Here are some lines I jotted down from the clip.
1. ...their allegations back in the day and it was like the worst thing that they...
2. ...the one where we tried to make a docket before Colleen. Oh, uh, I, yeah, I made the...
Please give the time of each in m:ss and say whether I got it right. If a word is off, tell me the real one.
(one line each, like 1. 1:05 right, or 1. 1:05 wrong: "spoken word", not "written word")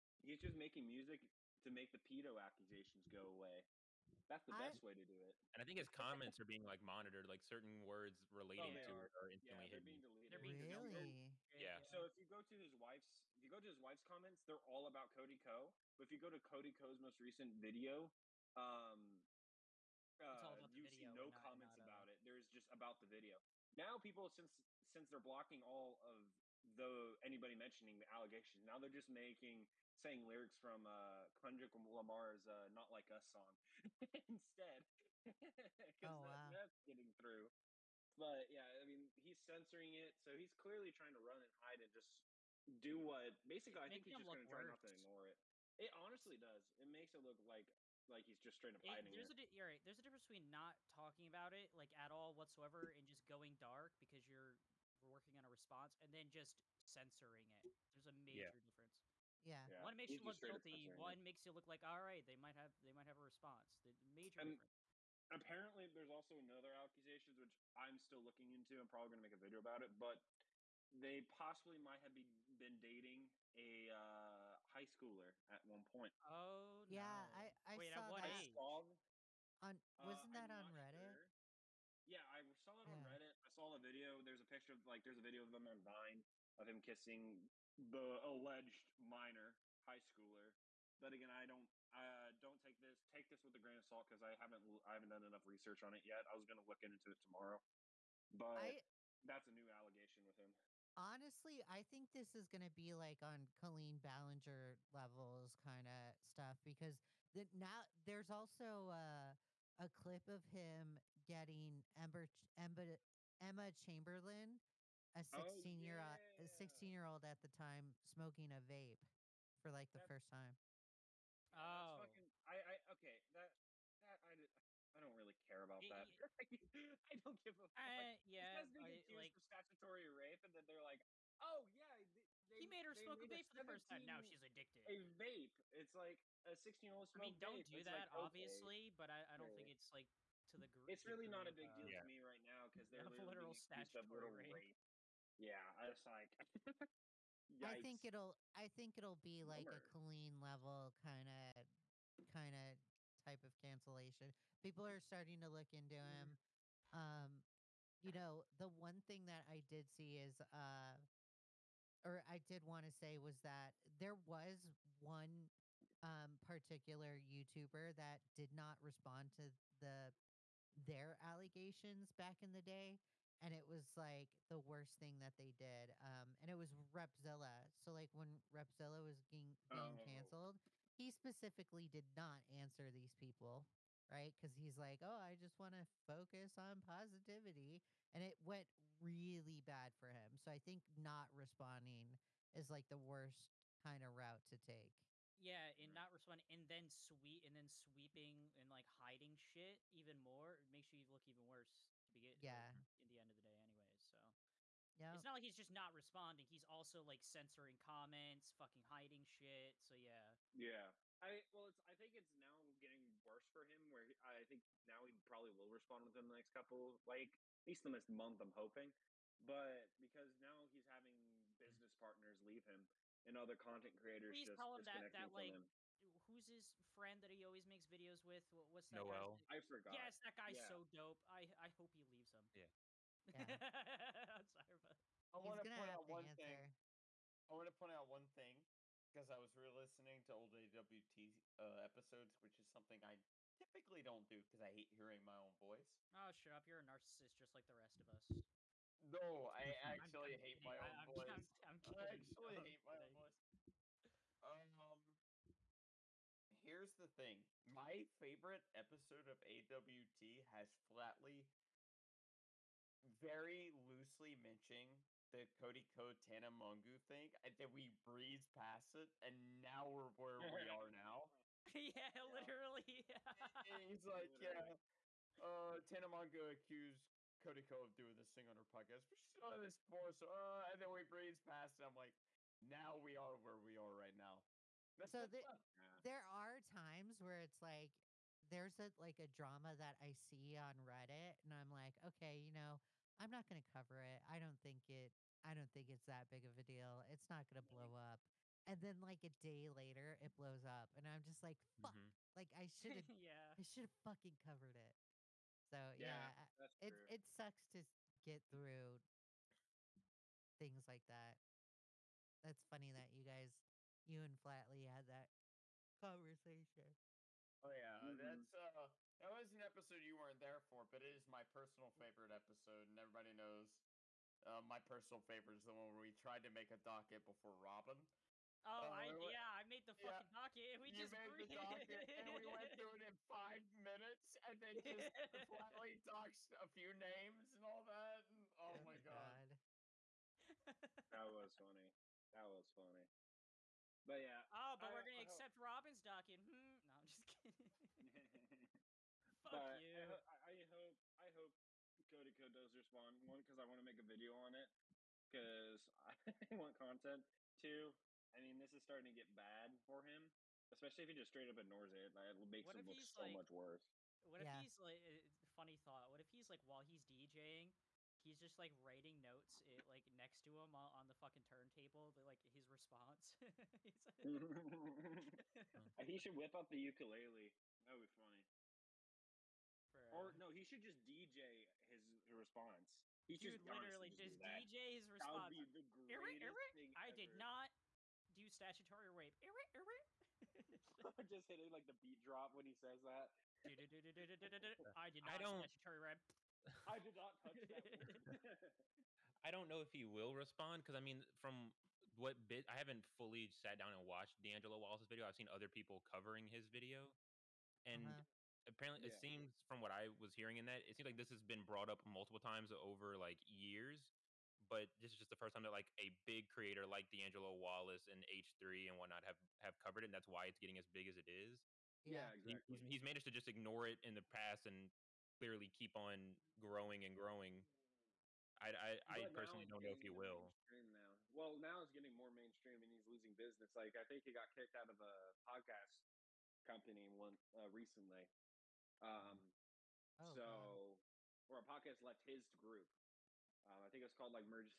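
1. 2:50 right
2. 5:25 wrong: "Robin", not "Colleen".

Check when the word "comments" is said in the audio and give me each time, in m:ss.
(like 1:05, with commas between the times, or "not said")
0:05, 0:14, 0:21, 3:27.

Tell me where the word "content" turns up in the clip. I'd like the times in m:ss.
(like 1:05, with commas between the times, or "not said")
3:43, 5:56.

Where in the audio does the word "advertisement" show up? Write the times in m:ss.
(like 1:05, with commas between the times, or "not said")
not said.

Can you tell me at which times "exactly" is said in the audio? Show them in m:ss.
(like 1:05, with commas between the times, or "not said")
7:02.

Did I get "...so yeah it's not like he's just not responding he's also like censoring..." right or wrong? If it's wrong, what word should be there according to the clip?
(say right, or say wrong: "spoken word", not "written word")
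right.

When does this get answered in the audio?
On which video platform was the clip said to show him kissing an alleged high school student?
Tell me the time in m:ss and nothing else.
1:25.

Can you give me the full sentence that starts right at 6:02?
it makes what him look so like, much worse.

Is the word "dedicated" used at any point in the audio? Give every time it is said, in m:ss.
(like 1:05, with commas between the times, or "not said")
not said.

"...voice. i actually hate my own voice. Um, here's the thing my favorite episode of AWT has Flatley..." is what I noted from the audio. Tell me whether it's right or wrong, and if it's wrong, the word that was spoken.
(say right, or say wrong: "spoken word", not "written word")
right.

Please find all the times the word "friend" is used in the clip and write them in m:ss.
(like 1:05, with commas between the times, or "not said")
3:46.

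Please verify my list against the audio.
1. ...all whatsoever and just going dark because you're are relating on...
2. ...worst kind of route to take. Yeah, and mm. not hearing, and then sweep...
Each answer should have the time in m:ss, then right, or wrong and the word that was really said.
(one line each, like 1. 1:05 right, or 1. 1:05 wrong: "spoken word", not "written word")
1. 0:52 wrong: "working", not "relating"
2. 3:12 wrong: "responding", not "hearing".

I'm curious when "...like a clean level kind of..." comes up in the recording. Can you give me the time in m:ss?
2:29.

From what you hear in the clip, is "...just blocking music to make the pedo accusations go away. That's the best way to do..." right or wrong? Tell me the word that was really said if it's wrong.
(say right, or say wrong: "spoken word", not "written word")
wrong: "making", not "blocking".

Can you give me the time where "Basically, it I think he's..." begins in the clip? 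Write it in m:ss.
0:43.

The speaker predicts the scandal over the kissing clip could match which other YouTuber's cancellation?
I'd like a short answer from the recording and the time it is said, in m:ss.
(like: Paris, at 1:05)
Colleen Ballinger, at 1:43.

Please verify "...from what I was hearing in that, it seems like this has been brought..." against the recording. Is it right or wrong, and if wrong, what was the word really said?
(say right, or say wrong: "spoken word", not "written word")
right.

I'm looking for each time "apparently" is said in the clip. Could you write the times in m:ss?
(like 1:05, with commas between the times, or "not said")
1:05, 6:48.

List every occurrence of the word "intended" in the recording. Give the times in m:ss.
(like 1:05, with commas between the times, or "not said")
not said.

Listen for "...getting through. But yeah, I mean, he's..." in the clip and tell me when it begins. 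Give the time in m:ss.
0:36.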